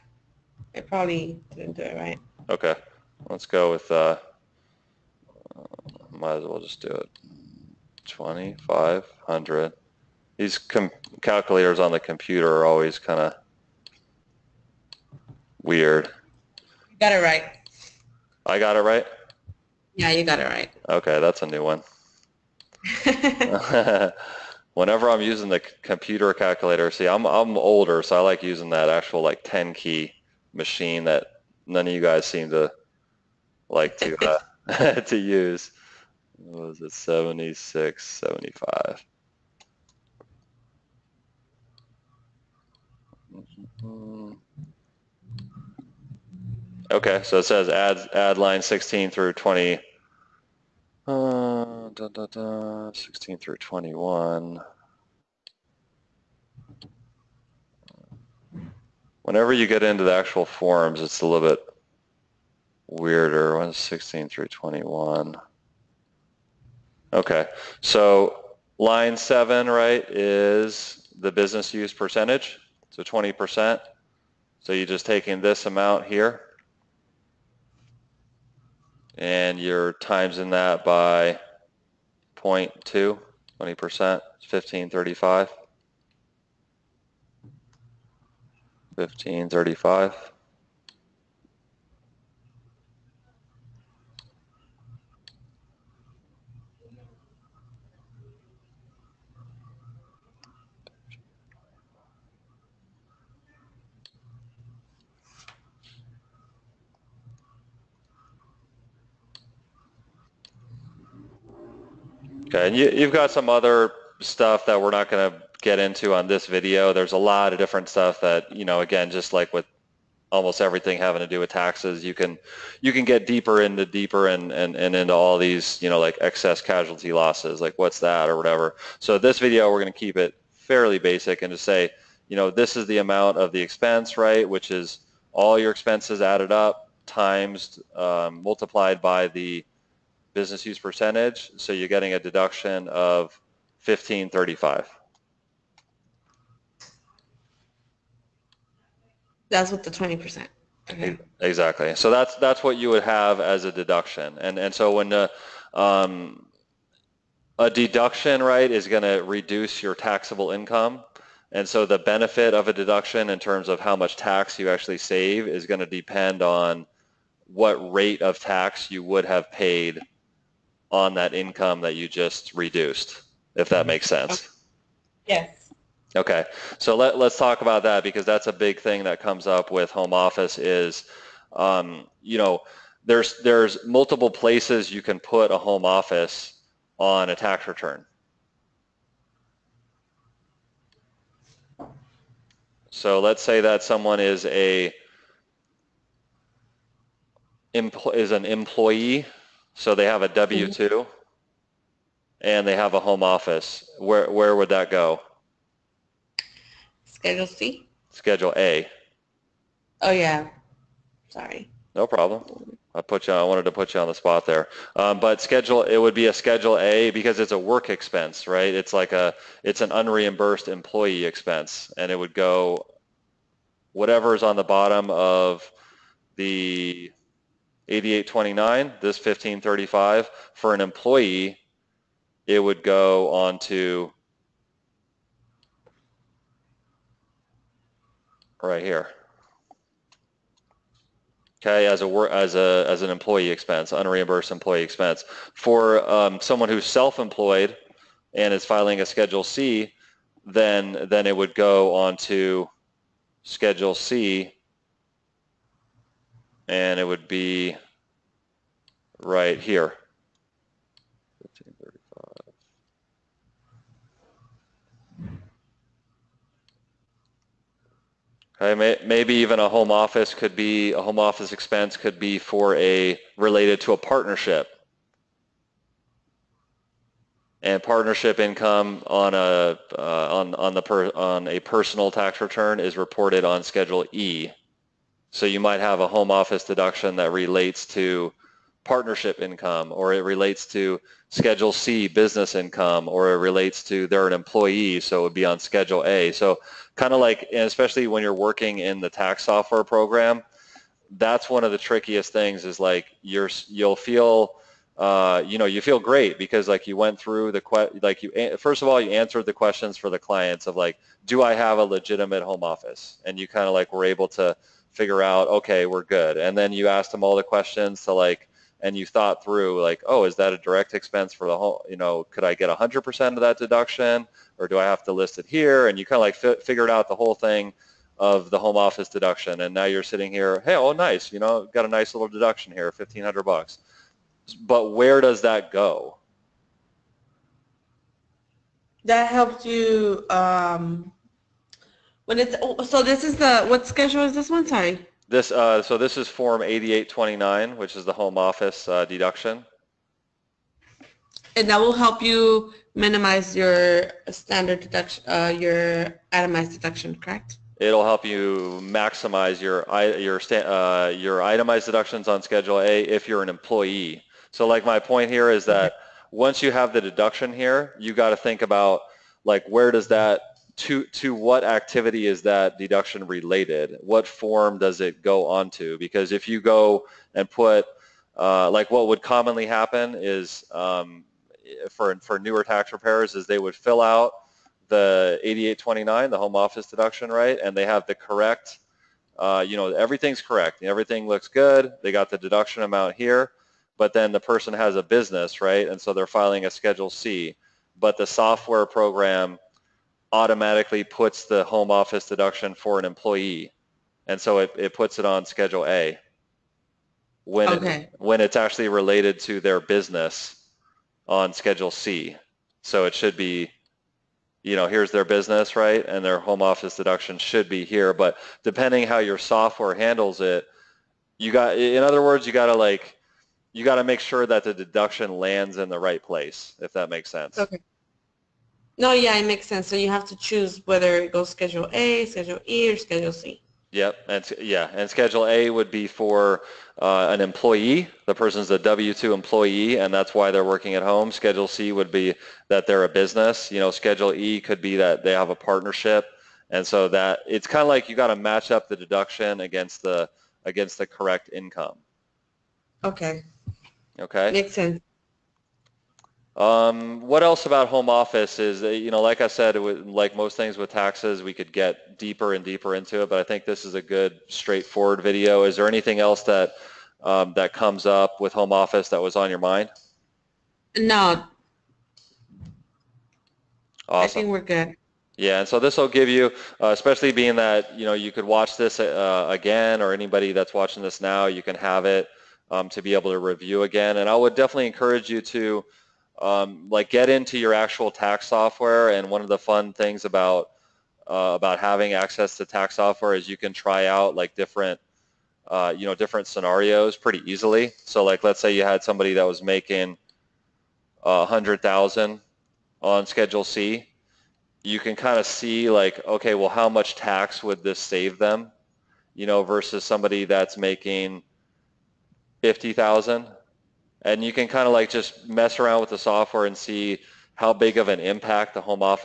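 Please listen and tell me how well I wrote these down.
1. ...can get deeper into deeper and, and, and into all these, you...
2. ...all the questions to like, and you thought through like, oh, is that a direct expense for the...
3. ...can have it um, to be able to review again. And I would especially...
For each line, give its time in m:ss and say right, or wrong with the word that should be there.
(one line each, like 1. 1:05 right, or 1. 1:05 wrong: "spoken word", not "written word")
1. 2:02 right
2. 5:17 right
3. 8:01 wrong: "definitely", not "especially".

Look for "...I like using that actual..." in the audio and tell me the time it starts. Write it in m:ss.
0:28.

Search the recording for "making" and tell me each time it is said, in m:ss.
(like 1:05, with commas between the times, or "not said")
8:19, 8:30.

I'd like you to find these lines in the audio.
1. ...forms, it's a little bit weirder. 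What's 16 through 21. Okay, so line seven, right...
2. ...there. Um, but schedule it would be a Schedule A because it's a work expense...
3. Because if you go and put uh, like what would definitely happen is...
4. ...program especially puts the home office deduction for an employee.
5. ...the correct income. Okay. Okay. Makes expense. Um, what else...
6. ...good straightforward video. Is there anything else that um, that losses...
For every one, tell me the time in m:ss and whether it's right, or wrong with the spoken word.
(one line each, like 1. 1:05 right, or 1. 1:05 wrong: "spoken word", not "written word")
1. 1:00 right
2. 3:34 right
3. 6:15 wrong: "commonly", not "definitely"
4. 6:38 wrong: "automatically", not "especially"
5. 7:30 wrong: "sense", not "expense"
6. 7:44 wrong: "comes", not "losses".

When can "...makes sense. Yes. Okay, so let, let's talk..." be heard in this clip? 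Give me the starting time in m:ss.
2:53.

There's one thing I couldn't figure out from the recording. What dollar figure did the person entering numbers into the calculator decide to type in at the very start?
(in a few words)
2,500.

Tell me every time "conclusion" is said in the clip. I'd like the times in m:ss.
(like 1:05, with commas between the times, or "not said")
not said.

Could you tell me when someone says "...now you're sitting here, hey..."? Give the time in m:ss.
5:29.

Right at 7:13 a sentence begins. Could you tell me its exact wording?
Yep, and yeah, and Schedule A would be for uh, an employee.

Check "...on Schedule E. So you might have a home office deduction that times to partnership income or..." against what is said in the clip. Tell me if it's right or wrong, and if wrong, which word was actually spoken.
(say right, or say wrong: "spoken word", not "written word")
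wrong: "relates", not "times".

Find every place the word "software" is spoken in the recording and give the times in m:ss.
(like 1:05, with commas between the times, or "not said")
4:59, 6:38, 6:59, 8:08, 8:12, 8:36.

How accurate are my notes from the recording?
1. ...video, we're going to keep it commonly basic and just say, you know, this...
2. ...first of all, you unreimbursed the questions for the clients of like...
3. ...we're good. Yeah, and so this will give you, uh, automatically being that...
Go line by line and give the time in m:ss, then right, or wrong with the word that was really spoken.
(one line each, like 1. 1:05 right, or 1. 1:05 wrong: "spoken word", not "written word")
1. 2:09 wrong: "fairly", not "commonly"
2. 5:08 wrong: "answered", not "unreimbursed"
3. 7:54 wrong: "especially", not "automatically".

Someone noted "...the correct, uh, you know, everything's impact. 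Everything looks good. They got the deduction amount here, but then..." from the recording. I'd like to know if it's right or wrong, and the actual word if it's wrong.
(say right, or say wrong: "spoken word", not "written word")
wrong: "correct", not "impact".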